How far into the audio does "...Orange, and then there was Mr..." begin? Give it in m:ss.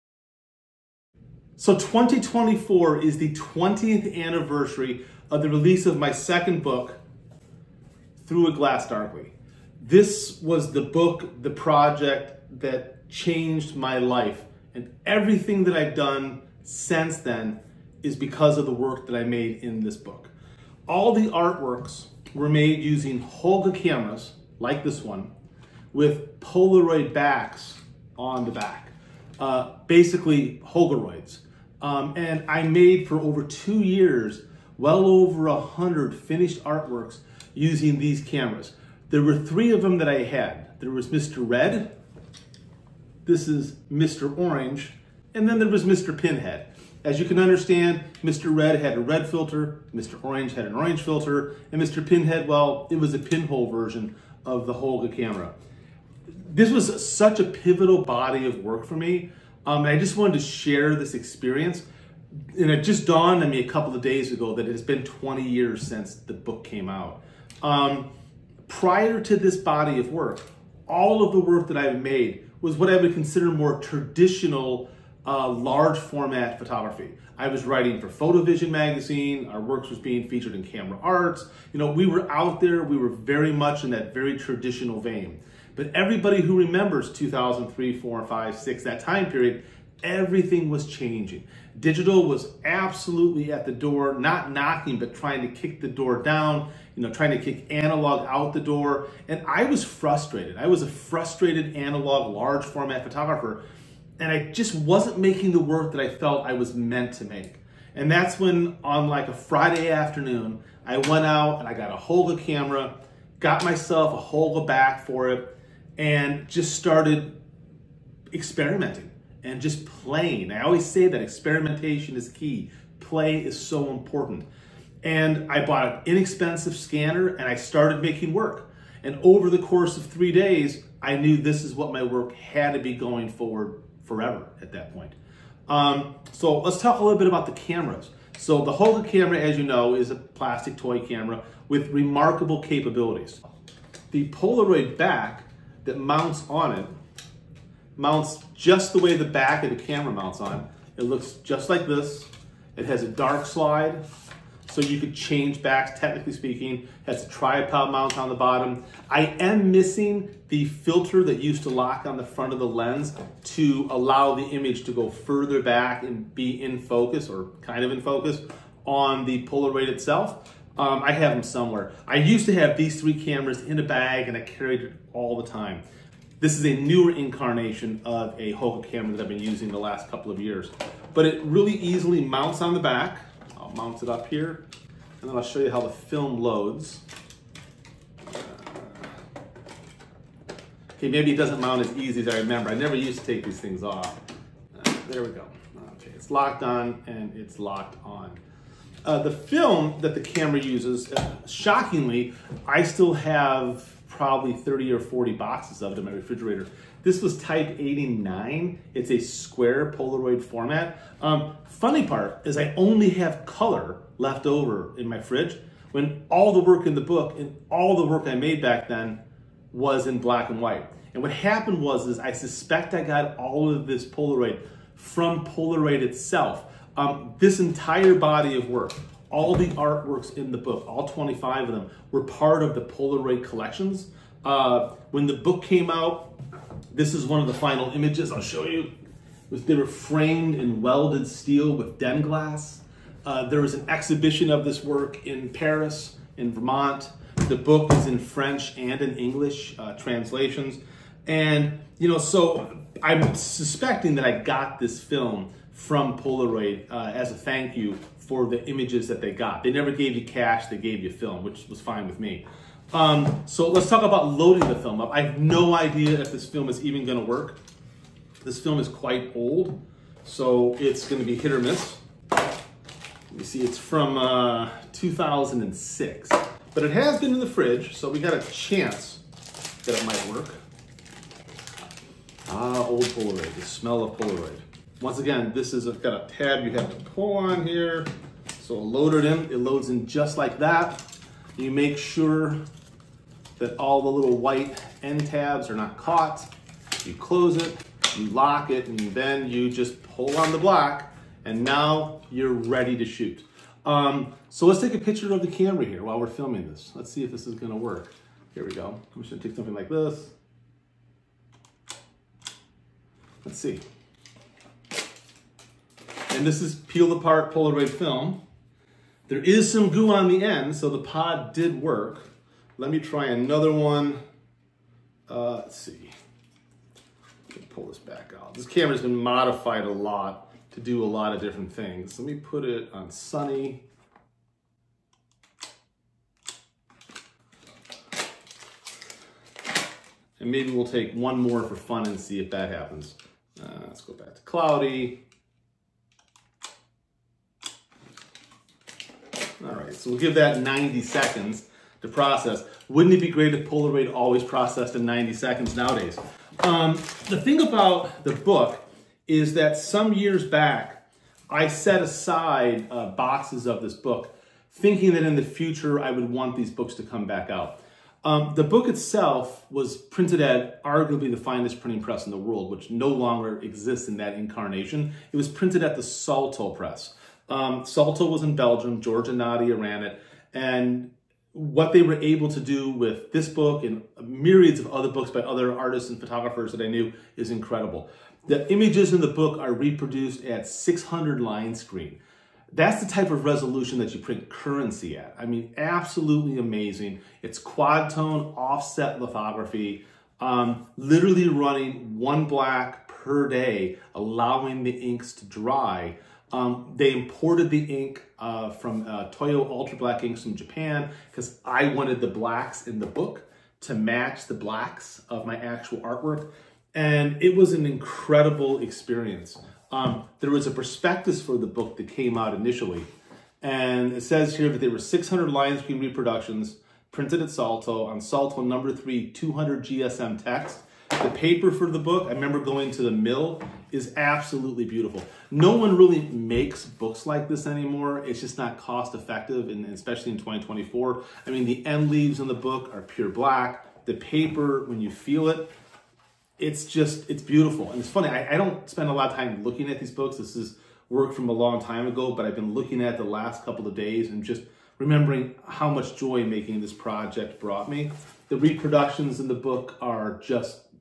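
0:44.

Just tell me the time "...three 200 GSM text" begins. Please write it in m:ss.
7:08.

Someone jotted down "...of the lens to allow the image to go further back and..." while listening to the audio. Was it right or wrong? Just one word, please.
right.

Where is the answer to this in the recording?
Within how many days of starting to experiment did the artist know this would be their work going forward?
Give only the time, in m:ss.
2:10.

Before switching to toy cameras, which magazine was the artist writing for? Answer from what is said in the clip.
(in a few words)
Photovision.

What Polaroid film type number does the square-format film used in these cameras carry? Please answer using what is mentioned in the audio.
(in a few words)
89.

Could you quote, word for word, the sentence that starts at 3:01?
But it really easily mounts on the back mount it up here, and then I'll show you how the film loads.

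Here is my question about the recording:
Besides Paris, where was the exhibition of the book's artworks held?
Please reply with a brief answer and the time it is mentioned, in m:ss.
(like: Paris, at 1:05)
Vermont, at 4:06.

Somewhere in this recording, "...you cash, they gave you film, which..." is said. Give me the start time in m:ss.
4:20.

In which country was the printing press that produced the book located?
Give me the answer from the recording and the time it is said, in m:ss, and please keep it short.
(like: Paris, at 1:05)
Belgium, at 6:18.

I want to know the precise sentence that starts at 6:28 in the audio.
The images in the book are reproduced at 600 line screen.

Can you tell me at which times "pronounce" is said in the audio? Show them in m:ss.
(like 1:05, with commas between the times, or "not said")
not said.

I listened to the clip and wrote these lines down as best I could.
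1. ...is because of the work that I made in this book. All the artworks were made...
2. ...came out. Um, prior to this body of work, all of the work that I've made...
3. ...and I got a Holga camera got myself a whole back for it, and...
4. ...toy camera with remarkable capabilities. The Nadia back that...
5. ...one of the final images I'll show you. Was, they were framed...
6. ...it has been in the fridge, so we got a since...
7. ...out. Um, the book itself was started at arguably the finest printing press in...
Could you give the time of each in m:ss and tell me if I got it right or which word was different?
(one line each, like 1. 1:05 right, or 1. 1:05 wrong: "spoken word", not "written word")
1. 0:18 right
2. 1:06 right
3. 1:51 right
4. 2:20 wrong: "Polaroid", not "Nadia"
5. 3:57 right
6. 4:36 wrong: "chance", not "since"
7. 6:07 wrong: "printed", not "started".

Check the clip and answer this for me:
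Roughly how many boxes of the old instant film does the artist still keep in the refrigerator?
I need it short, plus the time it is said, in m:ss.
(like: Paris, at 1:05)
30 or 40, at 3:24.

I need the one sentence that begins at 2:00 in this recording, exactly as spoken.
I always say that experimentation is key.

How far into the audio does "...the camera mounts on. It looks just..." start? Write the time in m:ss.
2:29.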